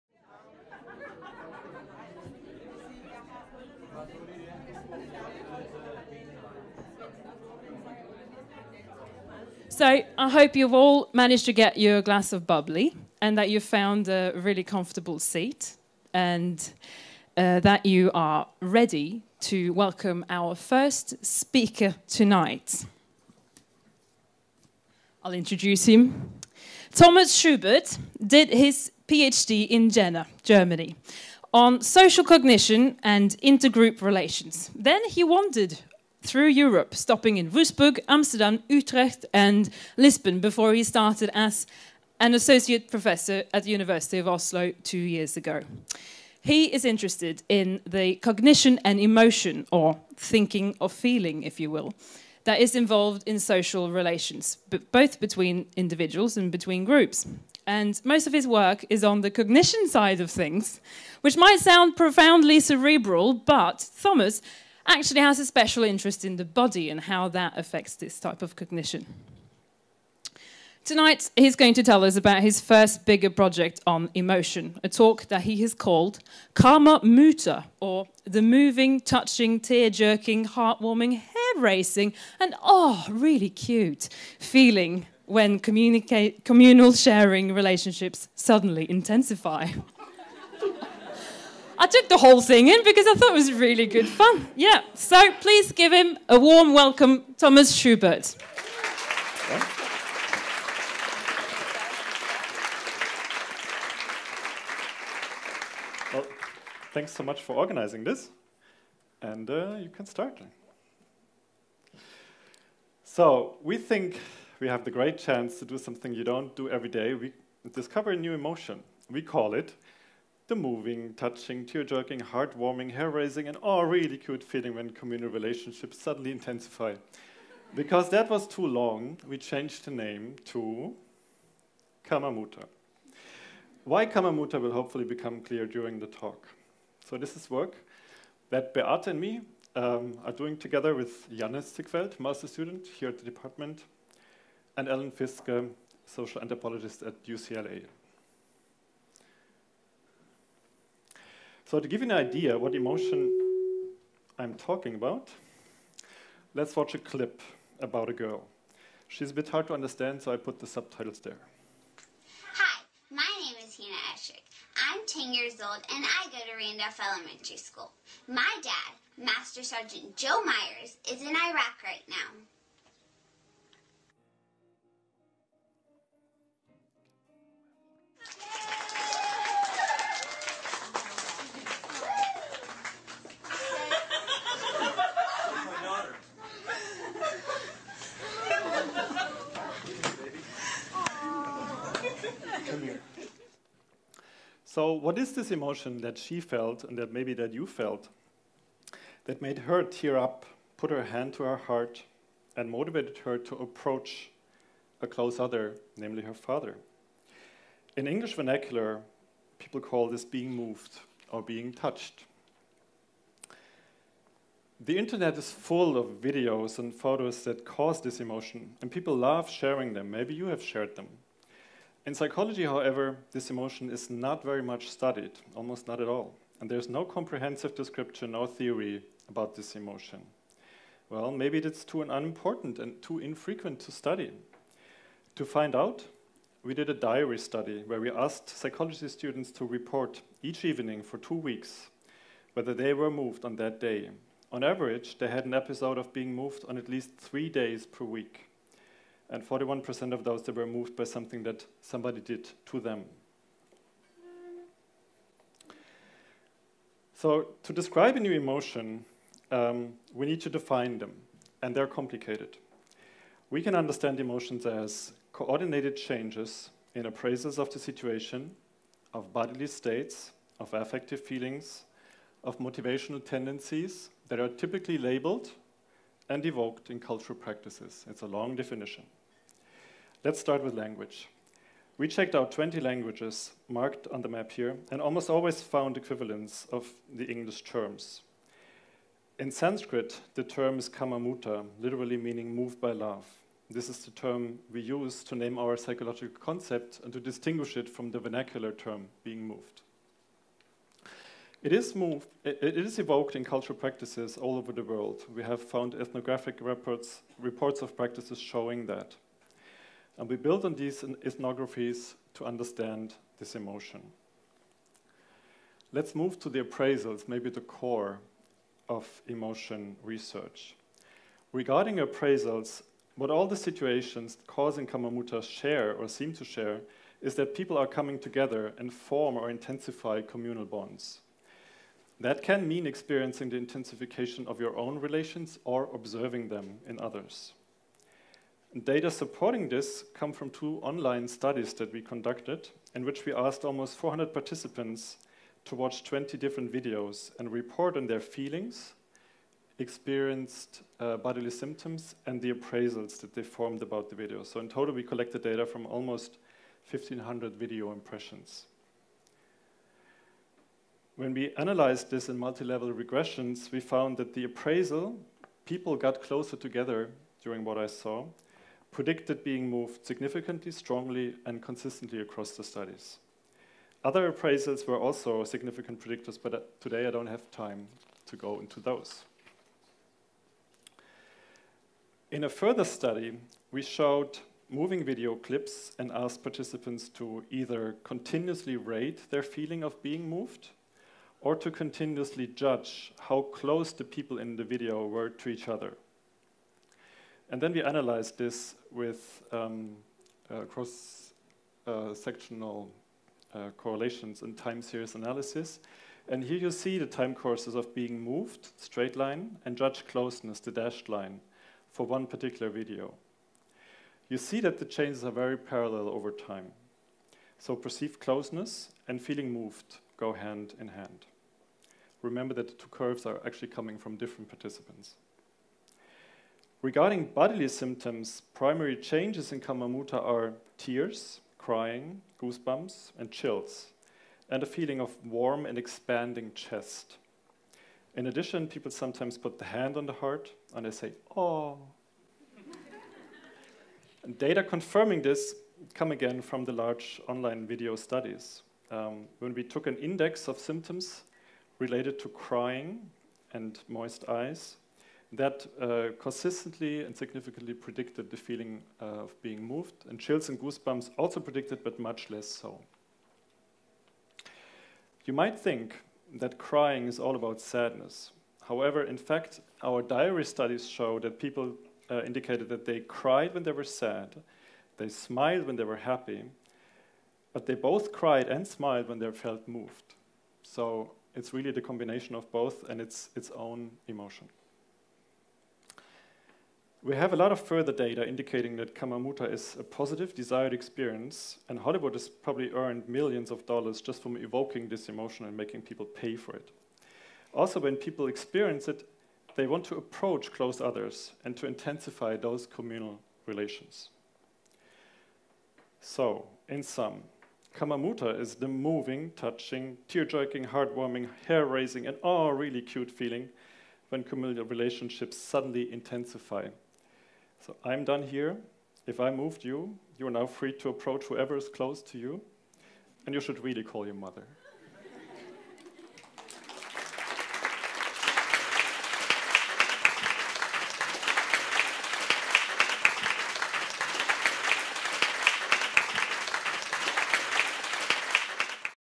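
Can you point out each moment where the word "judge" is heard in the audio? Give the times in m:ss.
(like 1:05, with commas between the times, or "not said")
6:32, 6:49.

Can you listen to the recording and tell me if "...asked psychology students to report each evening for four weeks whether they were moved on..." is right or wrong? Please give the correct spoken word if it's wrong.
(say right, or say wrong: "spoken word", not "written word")
wrong: "two", not "four".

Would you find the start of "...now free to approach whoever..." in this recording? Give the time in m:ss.
8:40.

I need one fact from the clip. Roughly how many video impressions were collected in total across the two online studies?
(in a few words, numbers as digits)
1,500.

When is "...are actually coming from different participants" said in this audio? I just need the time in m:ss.
7:03.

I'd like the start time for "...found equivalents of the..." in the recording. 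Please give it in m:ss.
4:45.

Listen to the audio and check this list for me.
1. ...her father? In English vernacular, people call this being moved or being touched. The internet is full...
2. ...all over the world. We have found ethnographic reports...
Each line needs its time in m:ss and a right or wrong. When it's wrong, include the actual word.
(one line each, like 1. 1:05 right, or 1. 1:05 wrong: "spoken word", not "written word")
1. 3:26 right
2. 5:04 right.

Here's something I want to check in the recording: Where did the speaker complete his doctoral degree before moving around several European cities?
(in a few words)
Jena.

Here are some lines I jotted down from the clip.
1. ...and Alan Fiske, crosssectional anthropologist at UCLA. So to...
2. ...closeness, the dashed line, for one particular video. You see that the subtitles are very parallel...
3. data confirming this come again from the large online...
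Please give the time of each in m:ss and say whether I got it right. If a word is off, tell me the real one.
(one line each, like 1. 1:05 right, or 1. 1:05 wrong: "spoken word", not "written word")
1. 2:24 wrong: "social", not "crosssectional"
2. 6:50 wrong: "changes", not "subtitles"
3. 7:24 right.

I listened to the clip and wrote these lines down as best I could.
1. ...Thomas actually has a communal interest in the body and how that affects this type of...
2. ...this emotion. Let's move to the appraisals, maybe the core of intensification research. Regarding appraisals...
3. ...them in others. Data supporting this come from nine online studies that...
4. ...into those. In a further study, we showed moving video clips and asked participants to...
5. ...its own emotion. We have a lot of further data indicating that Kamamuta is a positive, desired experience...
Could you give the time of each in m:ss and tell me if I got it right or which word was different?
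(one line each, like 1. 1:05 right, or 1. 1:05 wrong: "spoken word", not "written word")
1. 1:04 wrong: "special", not "communal"
2. 5:13 wrong: "emotion", not "intensification"
3. 5:36 wrong: "two", not "nine"
4. 6:18 right
5. 8:03 right.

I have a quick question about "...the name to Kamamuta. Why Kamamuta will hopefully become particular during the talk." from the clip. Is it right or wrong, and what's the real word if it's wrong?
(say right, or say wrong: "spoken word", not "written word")
wrong: "clear", not "particular".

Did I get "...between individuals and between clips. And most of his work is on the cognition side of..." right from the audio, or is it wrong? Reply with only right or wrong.
wrong.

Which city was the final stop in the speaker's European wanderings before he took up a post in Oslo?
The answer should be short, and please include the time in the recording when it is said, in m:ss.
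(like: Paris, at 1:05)
Lisbon, at 0:39.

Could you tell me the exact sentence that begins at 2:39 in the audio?
She's a bit hard to understand, so I put the subtitles there.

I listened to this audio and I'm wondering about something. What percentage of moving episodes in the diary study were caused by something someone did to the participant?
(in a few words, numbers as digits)
41%.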